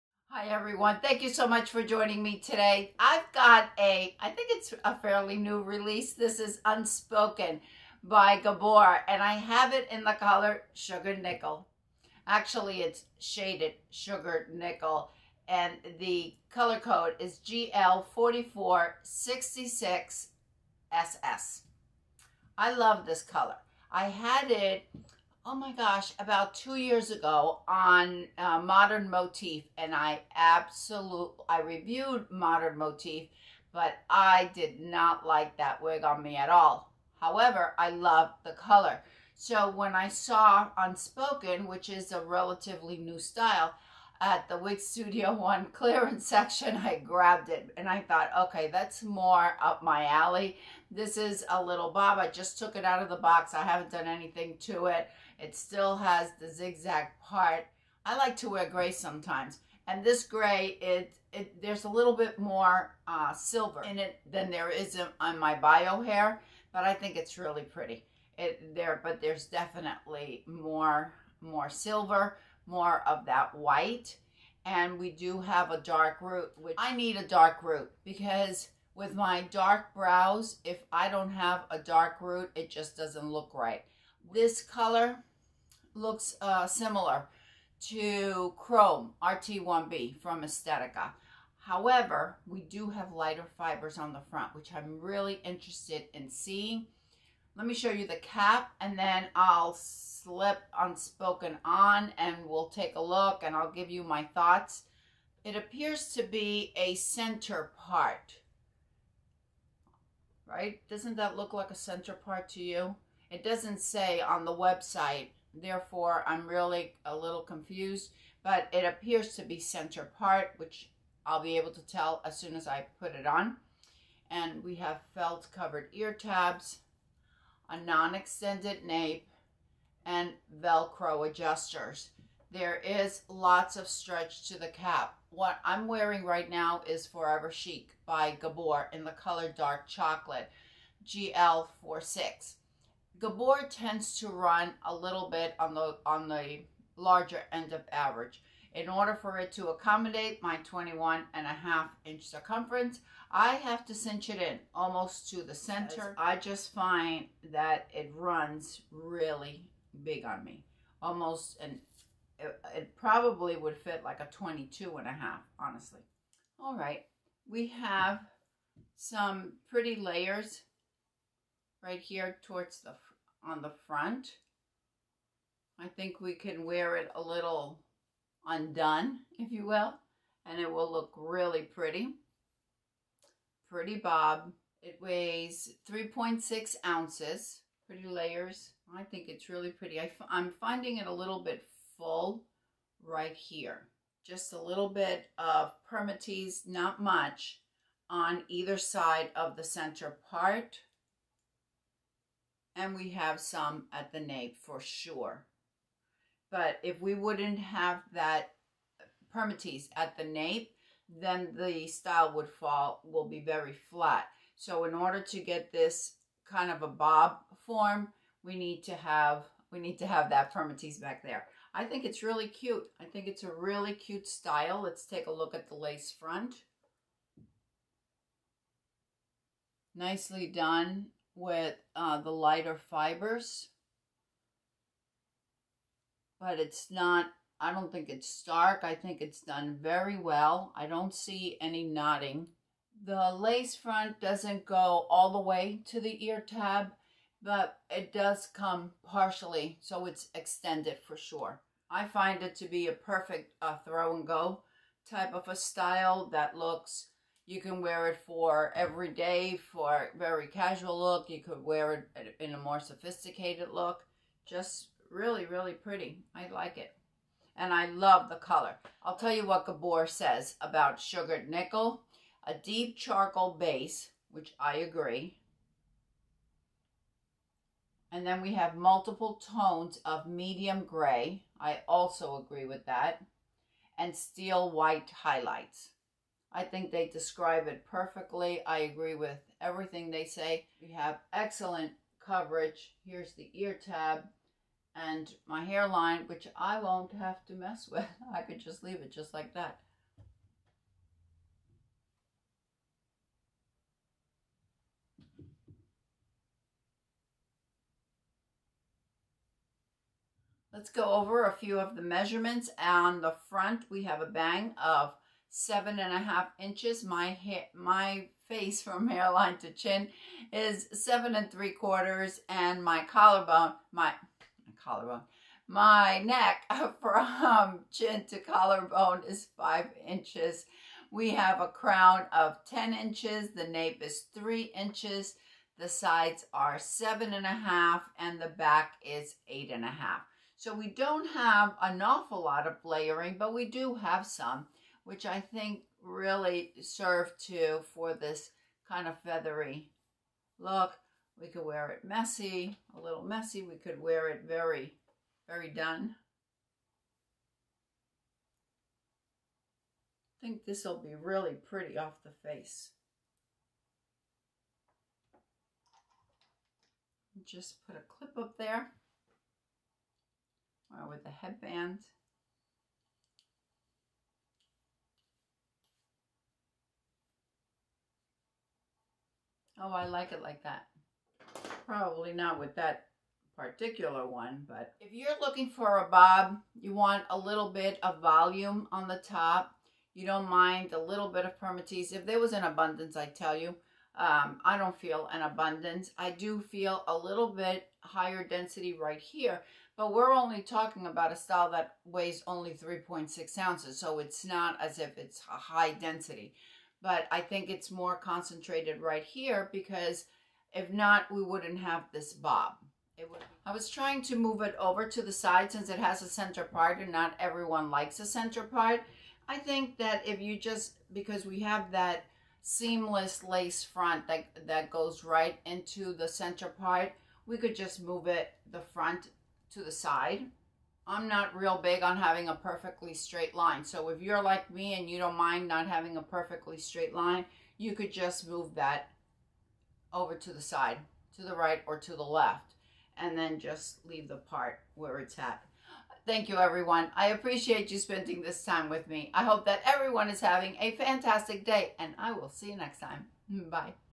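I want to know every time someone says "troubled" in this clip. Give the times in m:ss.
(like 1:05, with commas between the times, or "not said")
not said.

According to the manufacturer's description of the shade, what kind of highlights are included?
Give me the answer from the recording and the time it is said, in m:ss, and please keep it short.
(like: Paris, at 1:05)
steel white, at 4:44.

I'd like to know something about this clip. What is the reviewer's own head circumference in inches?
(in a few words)
21.5 inches.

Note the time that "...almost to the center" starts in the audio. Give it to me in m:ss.
2:34.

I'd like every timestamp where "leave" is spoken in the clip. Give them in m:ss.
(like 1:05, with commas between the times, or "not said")
4:58, 7:24.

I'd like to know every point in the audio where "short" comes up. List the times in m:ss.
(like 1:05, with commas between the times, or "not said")
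not said.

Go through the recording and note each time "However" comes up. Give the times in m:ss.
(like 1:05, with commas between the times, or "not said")
0:37, 1:31.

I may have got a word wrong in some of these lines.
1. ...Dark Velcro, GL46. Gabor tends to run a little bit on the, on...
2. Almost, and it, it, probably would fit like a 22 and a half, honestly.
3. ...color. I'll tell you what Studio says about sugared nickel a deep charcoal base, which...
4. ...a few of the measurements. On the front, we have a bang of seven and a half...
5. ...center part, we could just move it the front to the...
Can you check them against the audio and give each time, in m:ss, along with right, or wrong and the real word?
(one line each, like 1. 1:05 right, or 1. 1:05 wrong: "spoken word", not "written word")
1. 2:19 wrong: "Chocolate", not "Velcro"
2. 2:41 right
3. 4:28 wrong: "Gabor", not "Studio"
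4. 5:11 right
5. 7:06 right.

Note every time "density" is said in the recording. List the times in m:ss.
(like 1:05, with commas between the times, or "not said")
6:38, 6:45.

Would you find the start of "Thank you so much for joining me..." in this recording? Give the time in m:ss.
0:01.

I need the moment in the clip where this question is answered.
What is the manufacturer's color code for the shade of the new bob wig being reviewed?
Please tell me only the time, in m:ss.
0:17.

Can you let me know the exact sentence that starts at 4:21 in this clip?
You could wear it in a more sophisticated look.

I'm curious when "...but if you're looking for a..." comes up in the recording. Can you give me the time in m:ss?
6:24.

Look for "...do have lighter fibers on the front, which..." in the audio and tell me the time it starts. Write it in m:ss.
1:32.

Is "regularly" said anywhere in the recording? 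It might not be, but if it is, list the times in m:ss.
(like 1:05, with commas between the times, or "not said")
not said.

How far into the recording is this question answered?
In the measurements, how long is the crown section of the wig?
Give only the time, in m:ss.
5:32.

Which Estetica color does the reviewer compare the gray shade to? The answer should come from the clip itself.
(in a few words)
Chrome RT1B.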